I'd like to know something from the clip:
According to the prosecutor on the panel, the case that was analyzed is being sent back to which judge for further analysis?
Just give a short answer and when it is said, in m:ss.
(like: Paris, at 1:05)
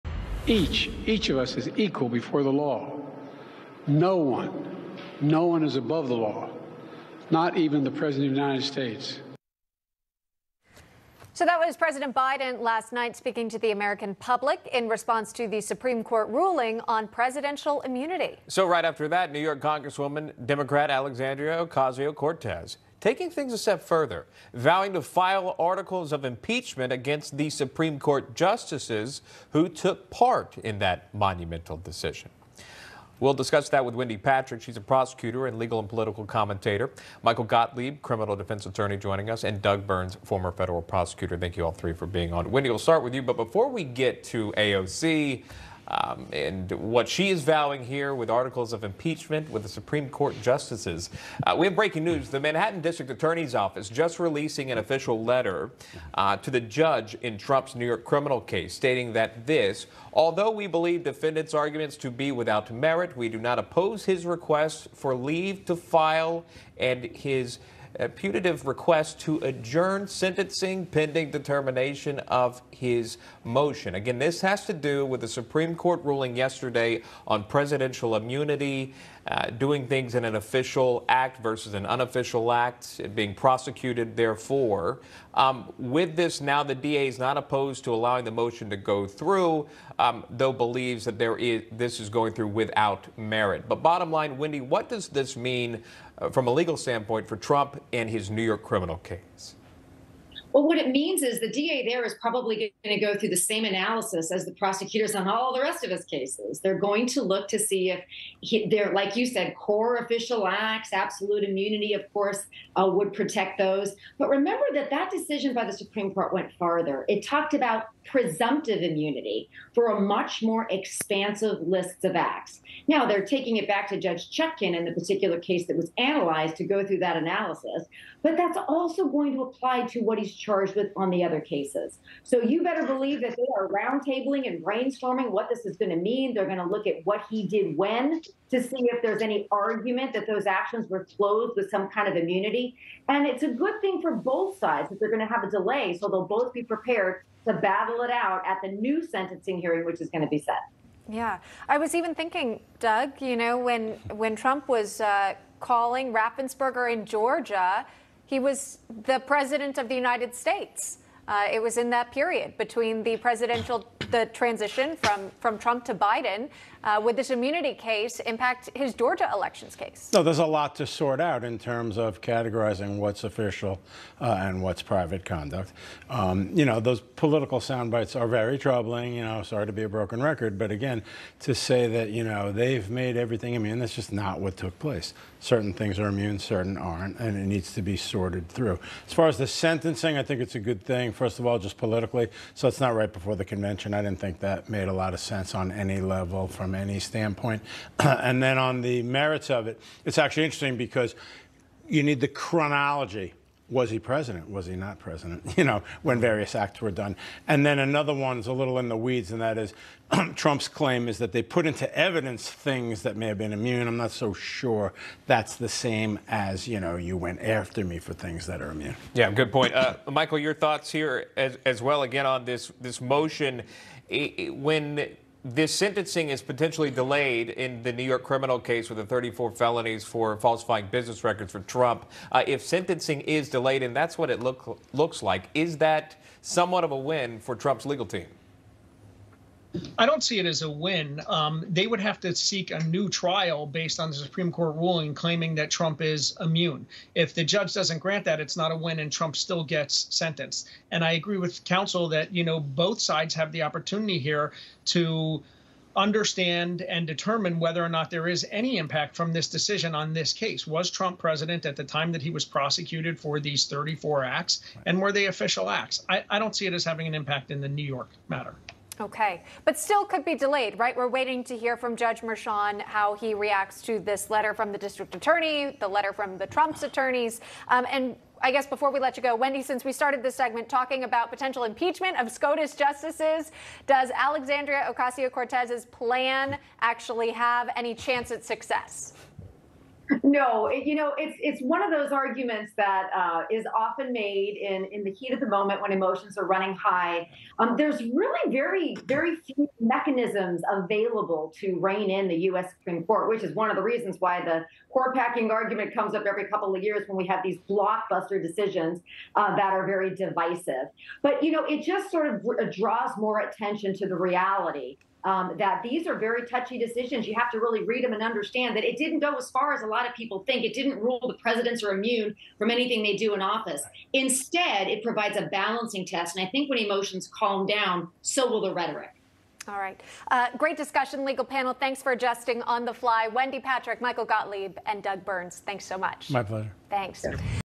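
Judge Chutkan, at 2:03.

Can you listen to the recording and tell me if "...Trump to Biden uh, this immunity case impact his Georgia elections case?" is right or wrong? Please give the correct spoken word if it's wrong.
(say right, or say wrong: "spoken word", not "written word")
right.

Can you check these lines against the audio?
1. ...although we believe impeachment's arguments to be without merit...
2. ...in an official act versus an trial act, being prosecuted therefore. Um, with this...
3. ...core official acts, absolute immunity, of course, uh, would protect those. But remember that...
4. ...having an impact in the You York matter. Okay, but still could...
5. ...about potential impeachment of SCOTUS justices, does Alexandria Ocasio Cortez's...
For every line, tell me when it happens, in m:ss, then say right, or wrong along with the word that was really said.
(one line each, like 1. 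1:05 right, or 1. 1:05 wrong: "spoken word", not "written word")
1. 1:00 wrong: "defendant", not "impeachment"
2. 1:20 wrong: "unofficial", not "trial"
3. 1:49 right
4. 4:26 wrong: "New", not "You"
5. 4:41 right.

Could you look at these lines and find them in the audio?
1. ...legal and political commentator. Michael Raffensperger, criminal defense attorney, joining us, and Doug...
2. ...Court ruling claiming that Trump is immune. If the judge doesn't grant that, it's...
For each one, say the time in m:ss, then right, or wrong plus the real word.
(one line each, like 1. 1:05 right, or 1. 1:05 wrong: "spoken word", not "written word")
1. 0:35 wrong: "Gottlieb", not "Raffensperger"
2. 4:04 right.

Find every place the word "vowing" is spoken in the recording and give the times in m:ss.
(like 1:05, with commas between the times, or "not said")
0:24, 0:47.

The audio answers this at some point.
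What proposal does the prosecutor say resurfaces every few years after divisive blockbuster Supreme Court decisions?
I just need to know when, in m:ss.
5:04.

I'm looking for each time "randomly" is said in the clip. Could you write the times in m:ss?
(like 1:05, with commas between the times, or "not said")
not said.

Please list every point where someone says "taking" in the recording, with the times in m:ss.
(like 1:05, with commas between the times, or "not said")
0:23, 2:03.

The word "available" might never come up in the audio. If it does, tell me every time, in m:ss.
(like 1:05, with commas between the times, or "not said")
5:00.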